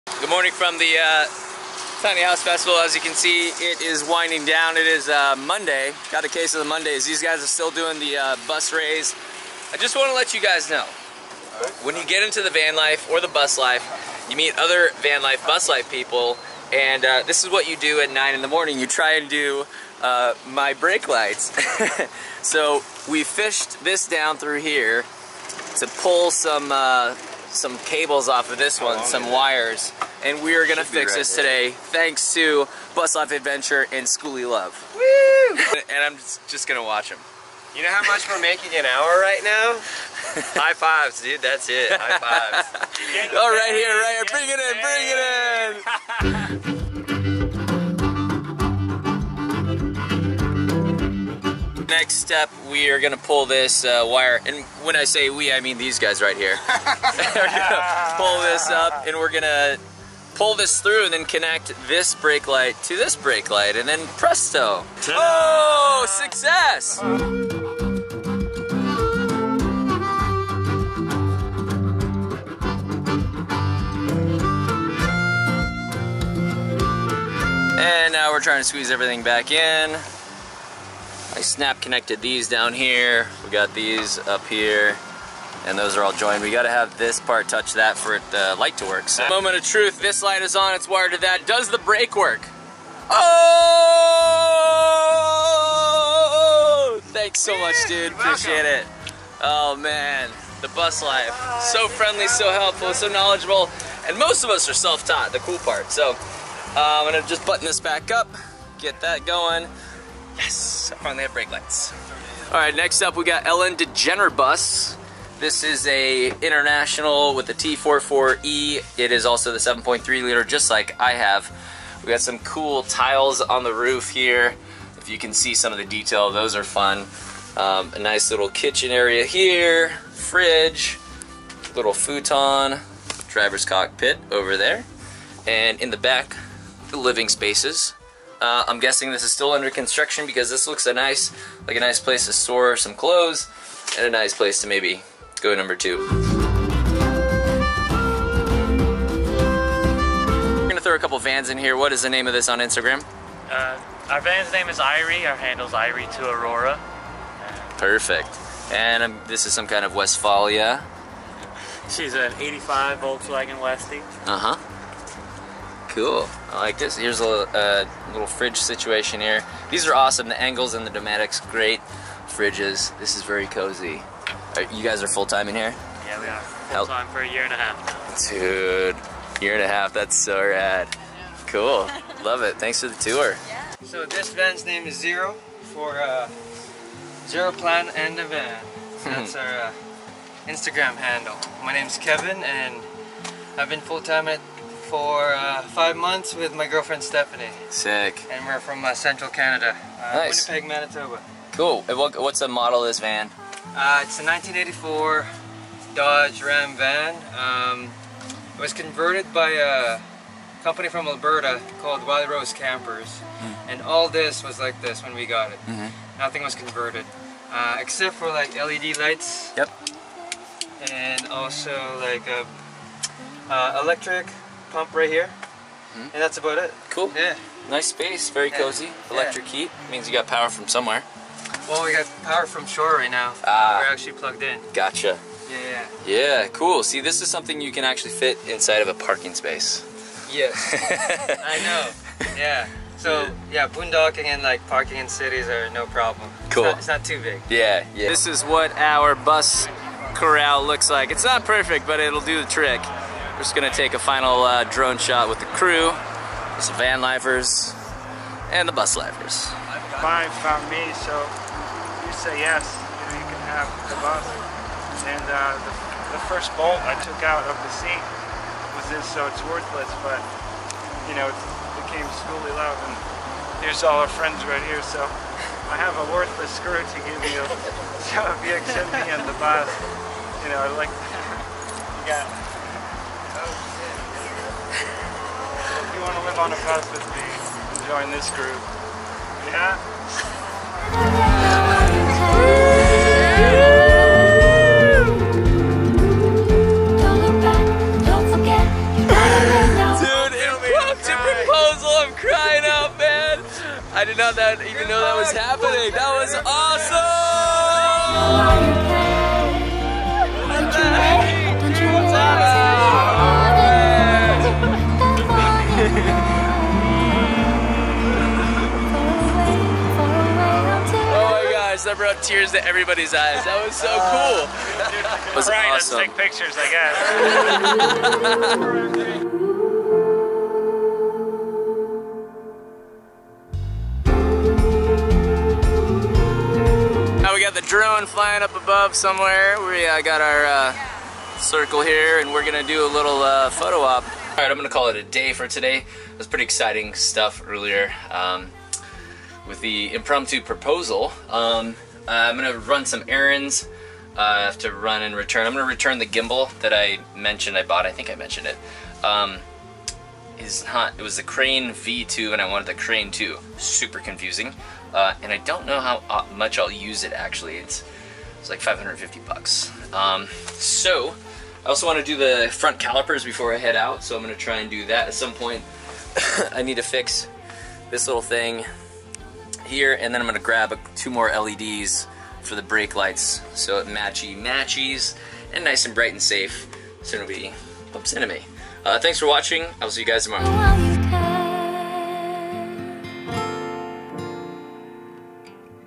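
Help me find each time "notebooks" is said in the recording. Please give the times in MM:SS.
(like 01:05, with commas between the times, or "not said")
not said.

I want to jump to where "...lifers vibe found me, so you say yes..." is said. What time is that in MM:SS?
04:18.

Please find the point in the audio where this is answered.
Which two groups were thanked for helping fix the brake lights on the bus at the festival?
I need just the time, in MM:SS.
00:32.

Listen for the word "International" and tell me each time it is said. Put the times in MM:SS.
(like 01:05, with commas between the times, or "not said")
01:56.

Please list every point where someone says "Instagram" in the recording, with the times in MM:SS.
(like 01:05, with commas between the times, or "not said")
02:32, 03:10.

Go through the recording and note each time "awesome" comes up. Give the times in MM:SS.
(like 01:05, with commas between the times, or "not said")
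02:49, 05:25.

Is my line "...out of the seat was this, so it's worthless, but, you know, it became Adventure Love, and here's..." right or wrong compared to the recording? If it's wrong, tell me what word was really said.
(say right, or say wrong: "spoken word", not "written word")
wrong: "Skoolie", not "Adventure".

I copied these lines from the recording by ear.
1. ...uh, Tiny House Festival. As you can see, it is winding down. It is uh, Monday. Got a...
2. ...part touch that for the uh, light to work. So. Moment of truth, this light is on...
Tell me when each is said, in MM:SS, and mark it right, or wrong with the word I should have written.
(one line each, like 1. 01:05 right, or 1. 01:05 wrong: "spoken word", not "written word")
1. 00:01 right
2. 01:27 right.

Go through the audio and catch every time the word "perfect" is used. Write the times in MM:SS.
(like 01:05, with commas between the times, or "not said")
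02:37, 04:11.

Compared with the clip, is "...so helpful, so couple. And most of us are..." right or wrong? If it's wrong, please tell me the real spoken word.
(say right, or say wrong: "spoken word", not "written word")
wrong: "knowledgeable", not "couple".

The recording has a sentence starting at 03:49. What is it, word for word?
Electric heat means you got power from somewhere.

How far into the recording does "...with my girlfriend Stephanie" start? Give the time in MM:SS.
03:16.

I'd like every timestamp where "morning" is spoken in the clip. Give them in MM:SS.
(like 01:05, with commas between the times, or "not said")
00:00, 00:18.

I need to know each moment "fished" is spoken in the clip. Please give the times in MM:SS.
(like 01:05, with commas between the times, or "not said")
00:23.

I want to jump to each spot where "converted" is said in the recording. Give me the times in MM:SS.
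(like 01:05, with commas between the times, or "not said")
03:28, 03:36.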